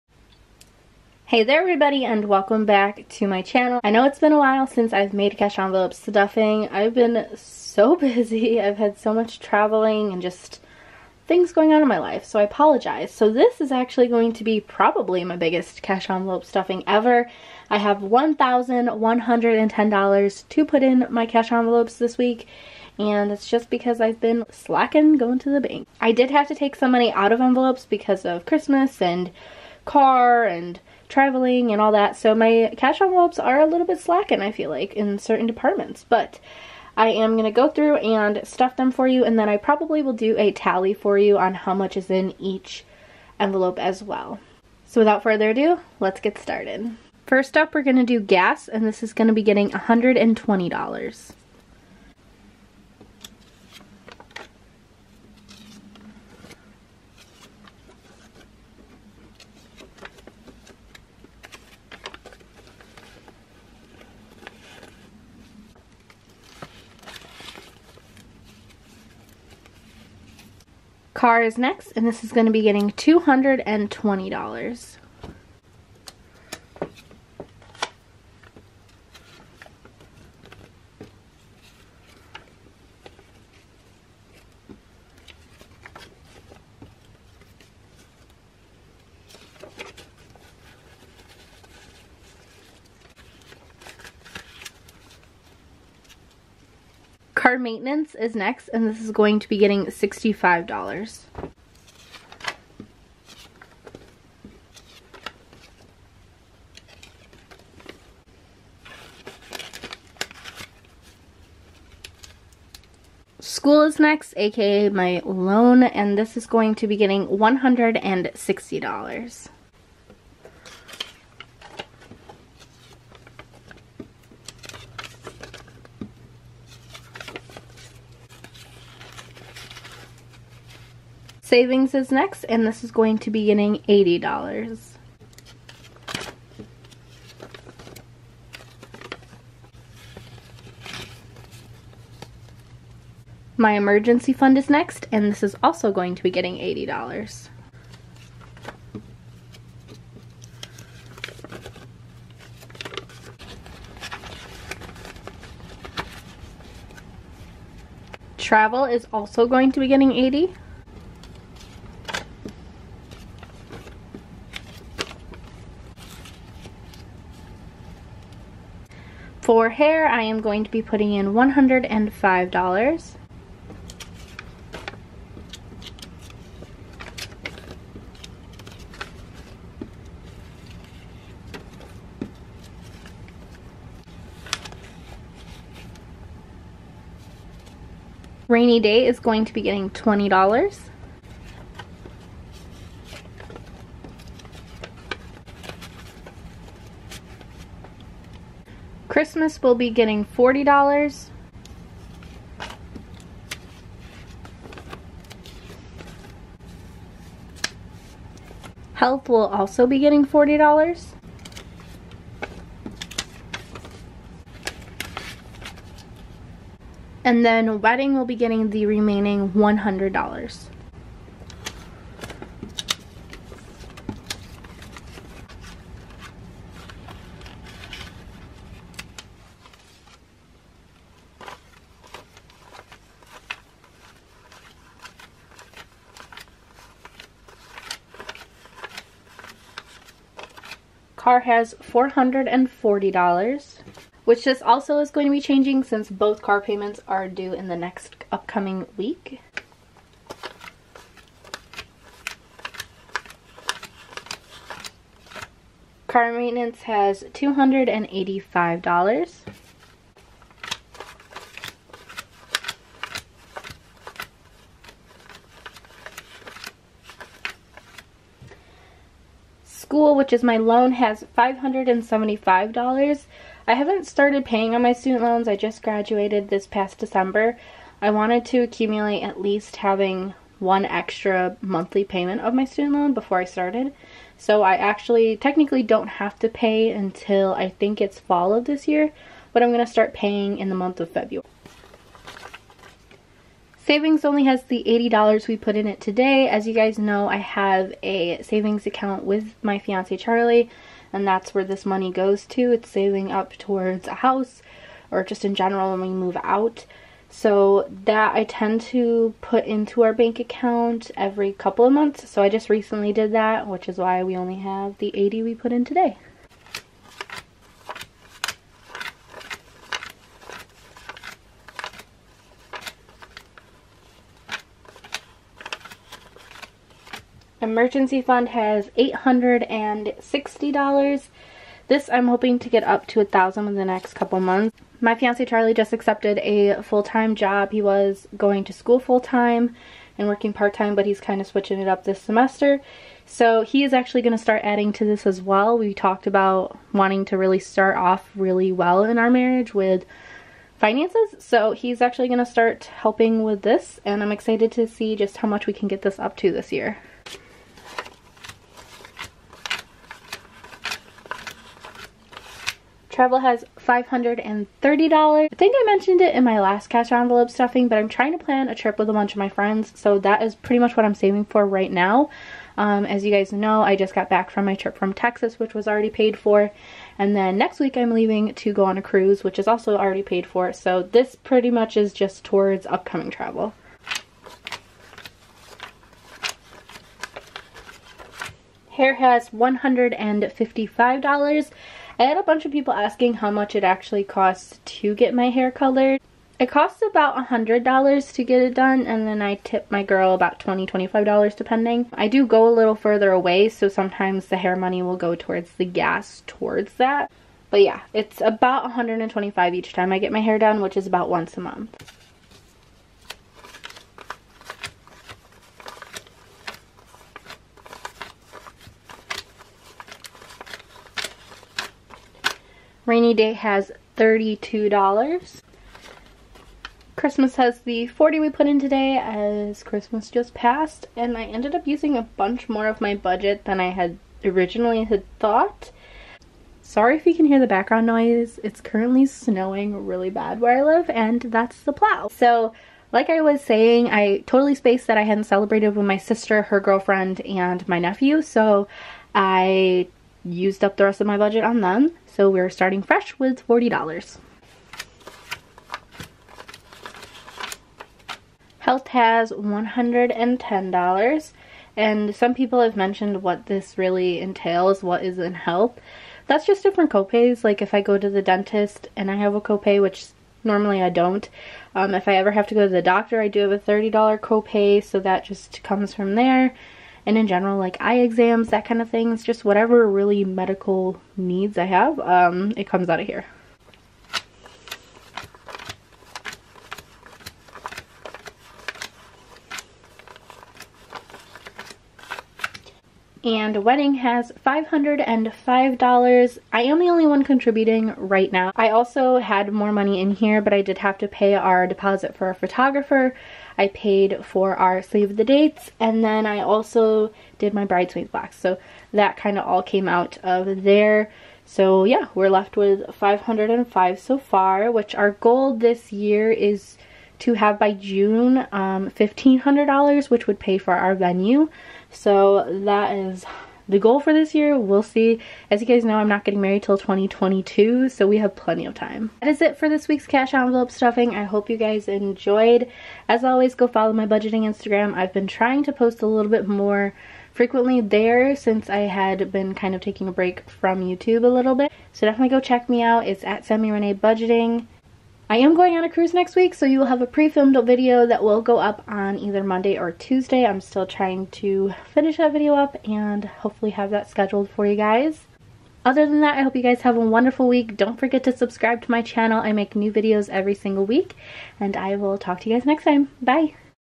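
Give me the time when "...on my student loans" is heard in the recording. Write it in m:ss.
4:34.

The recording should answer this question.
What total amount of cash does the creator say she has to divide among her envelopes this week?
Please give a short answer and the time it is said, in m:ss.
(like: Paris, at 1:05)
$1,110, at 0:17.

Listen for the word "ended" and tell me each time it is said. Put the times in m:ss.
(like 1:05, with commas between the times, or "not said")
7:11.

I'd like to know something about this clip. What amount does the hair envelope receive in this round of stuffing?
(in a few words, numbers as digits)
$105.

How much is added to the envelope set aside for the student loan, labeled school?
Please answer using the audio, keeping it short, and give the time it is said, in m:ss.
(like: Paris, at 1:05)
$160, at 1:57.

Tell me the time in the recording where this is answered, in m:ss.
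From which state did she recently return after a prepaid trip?
6:15.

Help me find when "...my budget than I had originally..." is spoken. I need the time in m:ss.
7:13.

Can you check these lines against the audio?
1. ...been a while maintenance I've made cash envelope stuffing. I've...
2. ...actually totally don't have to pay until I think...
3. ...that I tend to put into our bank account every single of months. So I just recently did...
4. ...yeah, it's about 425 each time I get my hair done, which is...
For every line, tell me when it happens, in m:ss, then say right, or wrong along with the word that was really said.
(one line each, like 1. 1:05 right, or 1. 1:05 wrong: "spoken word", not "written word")
1. 0:04 wrong: "since", not "maintenance"
2. 4:44 wrong: "technically", not "totally"
3. 5:08 wrong: "couple", not "single"
4. 6:47 wrong: "125", not "425".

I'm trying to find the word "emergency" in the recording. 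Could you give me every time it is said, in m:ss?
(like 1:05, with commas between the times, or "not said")
2:23, 5:27.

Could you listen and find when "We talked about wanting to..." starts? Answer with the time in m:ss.
5:45.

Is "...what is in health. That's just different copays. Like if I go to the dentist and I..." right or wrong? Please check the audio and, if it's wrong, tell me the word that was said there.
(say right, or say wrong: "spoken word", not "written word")
right.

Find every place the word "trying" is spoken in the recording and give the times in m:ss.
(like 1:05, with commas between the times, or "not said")
6:08, 8:55, 9:11.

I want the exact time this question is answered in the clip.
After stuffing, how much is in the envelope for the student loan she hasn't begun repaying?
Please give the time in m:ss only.
4:31.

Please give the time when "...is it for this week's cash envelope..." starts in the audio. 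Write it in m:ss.
8:49.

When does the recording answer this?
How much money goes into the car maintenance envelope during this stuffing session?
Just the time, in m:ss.
1:39.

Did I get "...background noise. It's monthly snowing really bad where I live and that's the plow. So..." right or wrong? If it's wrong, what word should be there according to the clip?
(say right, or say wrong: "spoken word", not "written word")
wrong: "currently", not "monthly".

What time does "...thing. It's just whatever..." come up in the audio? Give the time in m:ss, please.
7:59.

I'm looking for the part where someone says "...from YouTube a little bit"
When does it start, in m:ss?
9:00.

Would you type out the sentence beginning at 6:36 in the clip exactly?
It costs about $100 to get it done and then I tip my girl about $20, $25 depending.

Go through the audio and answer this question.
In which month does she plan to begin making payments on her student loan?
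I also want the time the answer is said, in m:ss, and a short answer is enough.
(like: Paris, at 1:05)
February, at 4:51.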